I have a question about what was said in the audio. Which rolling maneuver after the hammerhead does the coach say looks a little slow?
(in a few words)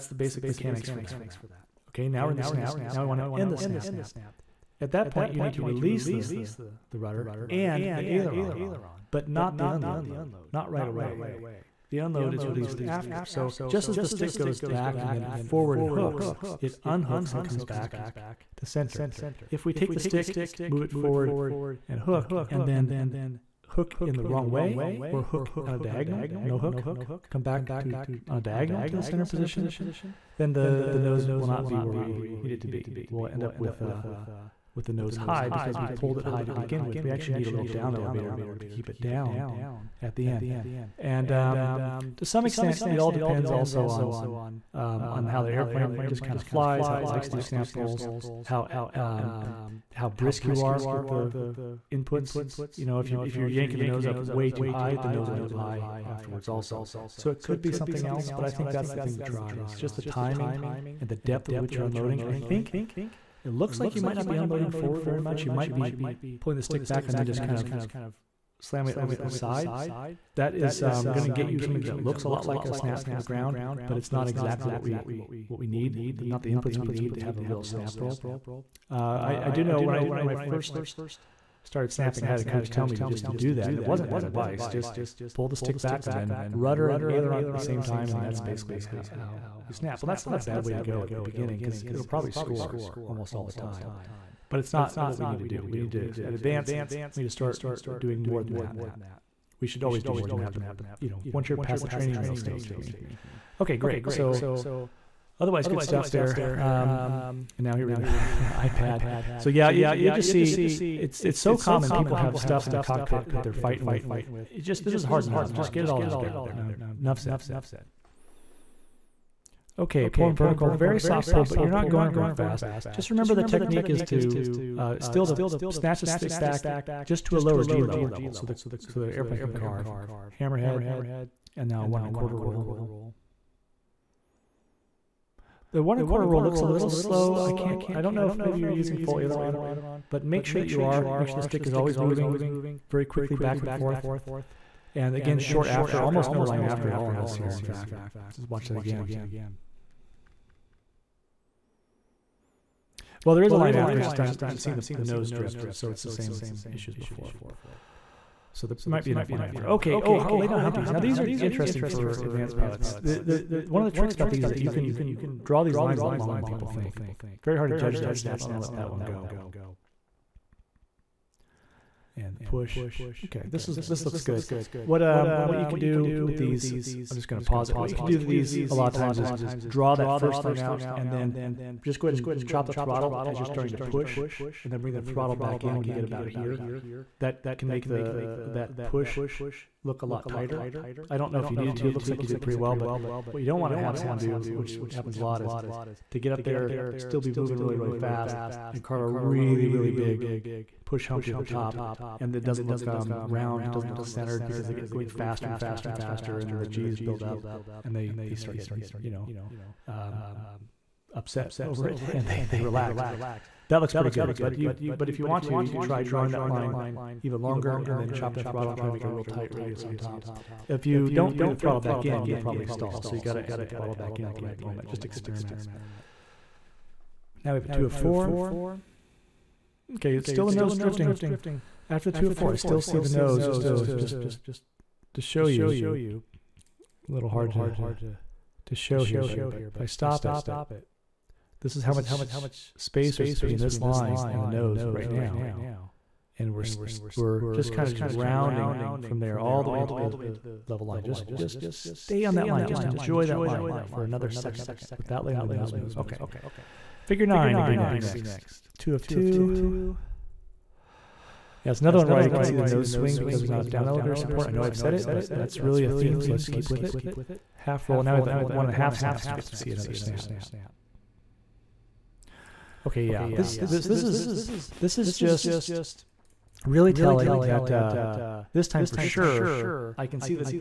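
One and a quarter roll.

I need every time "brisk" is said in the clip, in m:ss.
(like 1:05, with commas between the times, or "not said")
0:50.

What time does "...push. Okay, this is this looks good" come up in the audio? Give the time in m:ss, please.
2:52.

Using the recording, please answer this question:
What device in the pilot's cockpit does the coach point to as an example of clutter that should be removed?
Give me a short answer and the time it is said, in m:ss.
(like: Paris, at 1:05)
iPad, at 1:48.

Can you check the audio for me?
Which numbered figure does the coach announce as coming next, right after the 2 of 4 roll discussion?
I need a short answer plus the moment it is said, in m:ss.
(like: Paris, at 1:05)
Figure 9, at 4:17.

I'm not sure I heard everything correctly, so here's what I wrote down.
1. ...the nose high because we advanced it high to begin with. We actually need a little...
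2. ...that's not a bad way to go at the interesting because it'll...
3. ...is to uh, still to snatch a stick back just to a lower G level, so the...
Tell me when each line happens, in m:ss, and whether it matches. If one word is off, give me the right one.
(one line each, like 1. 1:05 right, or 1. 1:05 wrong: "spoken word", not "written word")
1. 0:34 wrong: "pulled", not "advanced"
2. 1:30 wrong: "beginning", not "interesting"
3. 2:03 right.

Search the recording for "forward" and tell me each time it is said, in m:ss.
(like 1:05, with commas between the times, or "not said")
0:15, 0:20, 1:04.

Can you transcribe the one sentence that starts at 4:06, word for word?
And we're we're just kind of just rounding from there all the way into the level line.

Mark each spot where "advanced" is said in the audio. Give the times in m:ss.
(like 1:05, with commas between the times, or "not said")
1:36, 2:42.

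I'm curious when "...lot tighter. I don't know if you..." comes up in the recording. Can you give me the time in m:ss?
3:10.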